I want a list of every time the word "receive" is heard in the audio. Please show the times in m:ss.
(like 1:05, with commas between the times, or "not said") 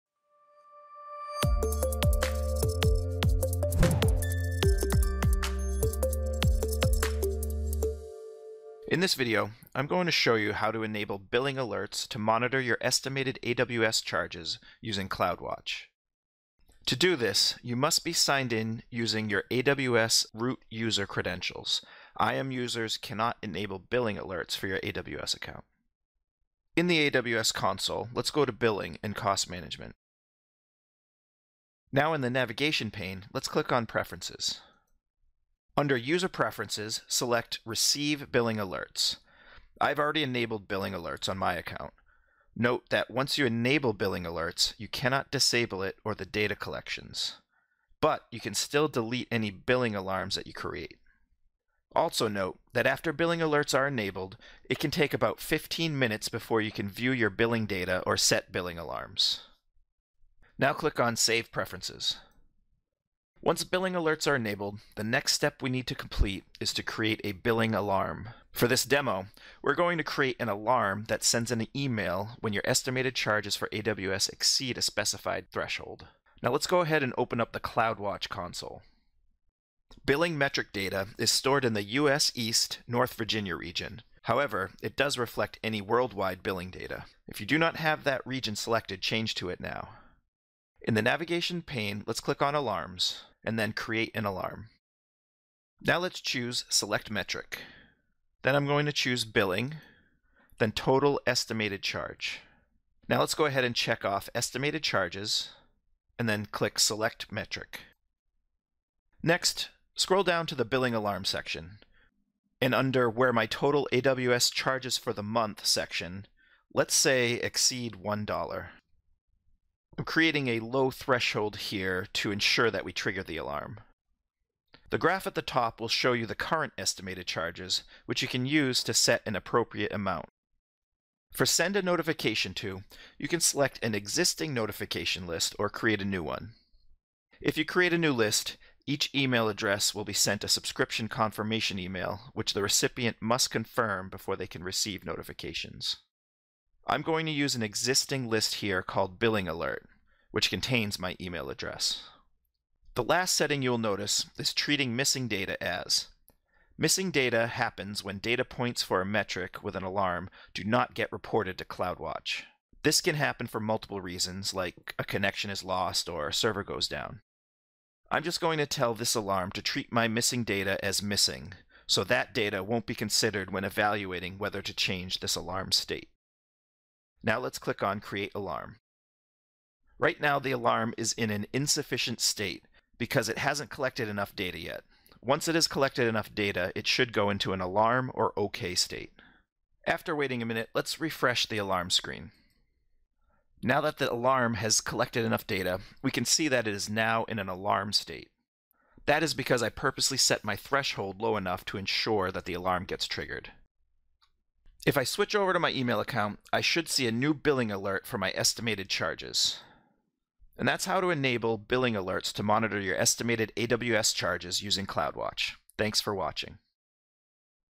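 0:37, 2:24.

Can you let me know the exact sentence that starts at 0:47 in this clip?
But you can still delete any billing alarms that you create.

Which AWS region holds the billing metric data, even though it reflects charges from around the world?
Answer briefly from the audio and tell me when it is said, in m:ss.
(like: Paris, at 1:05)
US East North Virginia, at 1:21.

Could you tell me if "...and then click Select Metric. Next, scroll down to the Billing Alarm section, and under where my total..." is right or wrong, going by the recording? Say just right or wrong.
right.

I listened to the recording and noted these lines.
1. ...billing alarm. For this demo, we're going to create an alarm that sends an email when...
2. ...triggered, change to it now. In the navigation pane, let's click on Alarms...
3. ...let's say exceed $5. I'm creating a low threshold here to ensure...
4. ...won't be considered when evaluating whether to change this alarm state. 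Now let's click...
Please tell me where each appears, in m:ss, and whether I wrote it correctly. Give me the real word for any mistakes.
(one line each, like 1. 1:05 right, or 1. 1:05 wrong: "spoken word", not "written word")
1. 1:07 right
2. 1:28 wrong: "selected", not "triggered"
3. 1:56 wrong: "1", not "5"
4. 2:52 right.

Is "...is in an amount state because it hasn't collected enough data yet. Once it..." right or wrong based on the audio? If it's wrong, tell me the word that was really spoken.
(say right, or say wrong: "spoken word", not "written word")
wrong: "insufficient", not "amount".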